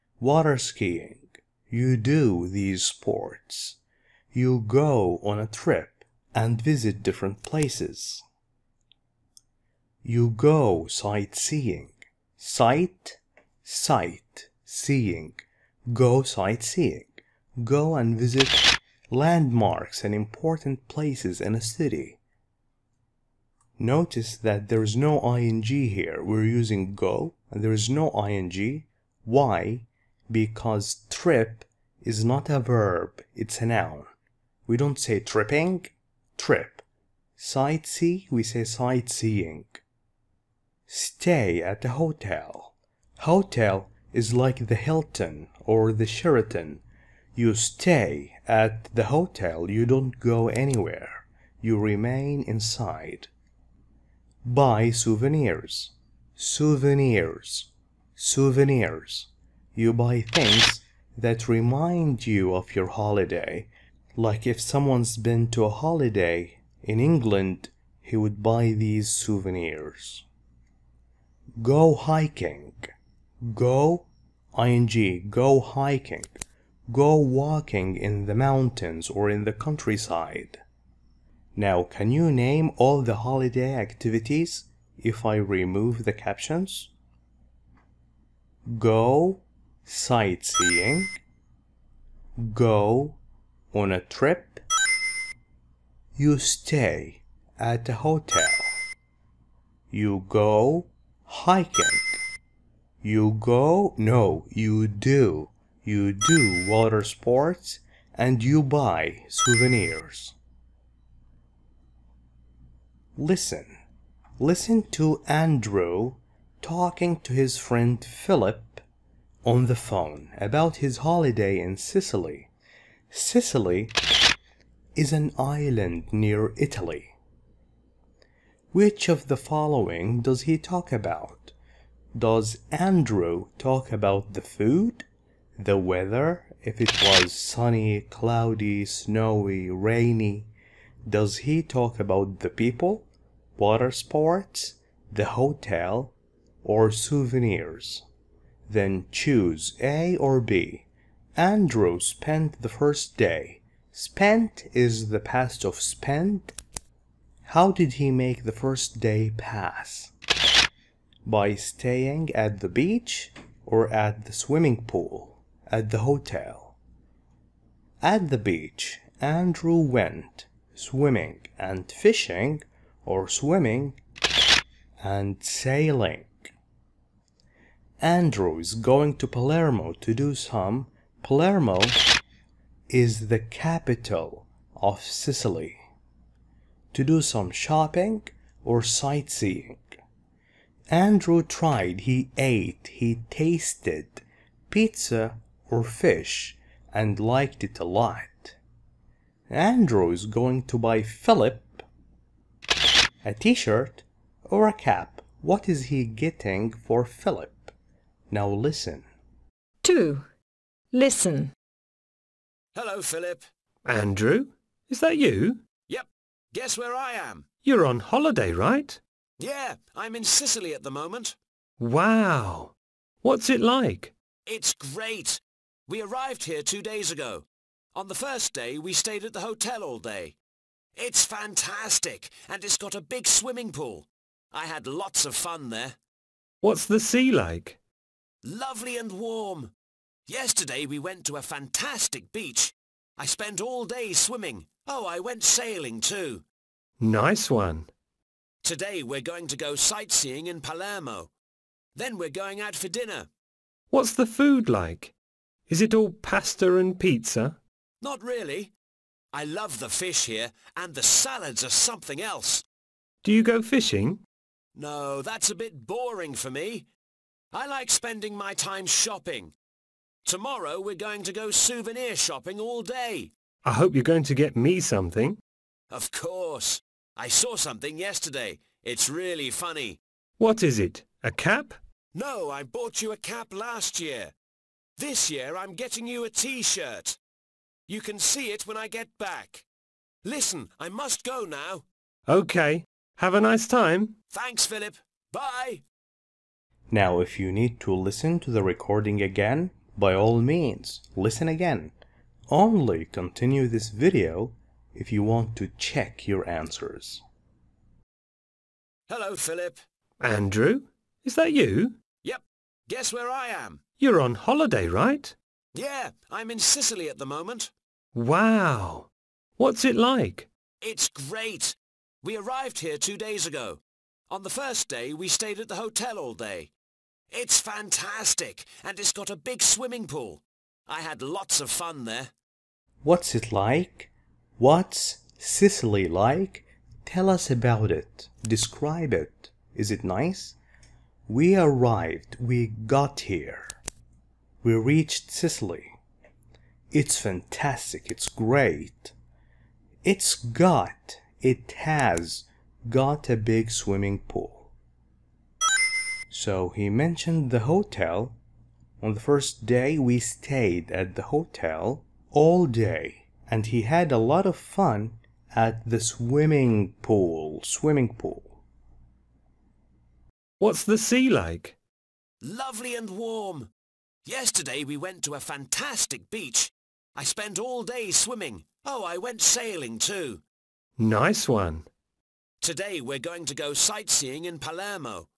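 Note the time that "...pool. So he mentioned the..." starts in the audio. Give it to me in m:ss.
5:54.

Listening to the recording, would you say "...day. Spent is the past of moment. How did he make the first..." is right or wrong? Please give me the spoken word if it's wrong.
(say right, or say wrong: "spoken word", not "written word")
wrong: "spent", not "moment".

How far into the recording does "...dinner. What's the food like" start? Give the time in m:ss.
4:12.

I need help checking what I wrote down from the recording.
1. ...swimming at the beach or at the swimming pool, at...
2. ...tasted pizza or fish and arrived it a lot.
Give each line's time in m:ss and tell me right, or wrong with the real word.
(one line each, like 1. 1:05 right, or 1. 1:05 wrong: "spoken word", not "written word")
1. 2:41 wrong: "staying", not "swimming"
2. 3:13 wrong: "liked", not "arrived".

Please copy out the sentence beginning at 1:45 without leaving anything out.
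You do water sports and you buy souvenirs.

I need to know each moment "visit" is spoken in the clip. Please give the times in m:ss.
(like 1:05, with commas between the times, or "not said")
0:06, 0:18.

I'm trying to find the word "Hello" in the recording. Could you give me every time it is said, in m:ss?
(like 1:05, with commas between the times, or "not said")
3:32, 5:09.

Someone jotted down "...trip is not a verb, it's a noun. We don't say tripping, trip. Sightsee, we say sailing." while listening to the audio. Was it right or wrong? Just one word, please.
wrong.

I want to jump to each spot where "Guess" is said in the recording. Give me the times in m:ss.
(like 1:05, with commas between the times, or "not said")
3:36, 5:12.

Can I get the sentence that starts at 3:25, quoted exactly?
What is he getting for Philip?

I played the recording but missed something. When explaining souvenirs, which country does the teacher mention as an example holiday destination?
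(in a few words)
England.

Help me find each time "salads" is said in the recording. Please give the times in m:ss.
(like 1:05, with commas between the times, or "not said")
4:21.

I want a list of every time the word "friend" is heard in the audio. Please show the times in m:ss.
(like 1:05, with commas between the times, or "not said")
1:57.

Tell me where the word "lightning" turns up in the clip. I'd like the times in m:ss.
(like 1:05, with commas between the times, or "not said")
not said.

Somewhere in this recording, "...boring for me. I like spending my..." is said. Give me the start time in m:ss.
4:25.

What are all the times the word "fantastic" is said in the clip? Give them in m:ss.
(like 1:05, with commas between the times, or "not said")
3:51, 4:01, 5:27, 5:47, 6:15.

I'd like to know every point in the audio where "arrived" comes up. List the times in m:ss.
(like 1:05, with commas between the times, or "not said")
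3:46, 5:22, 5:41.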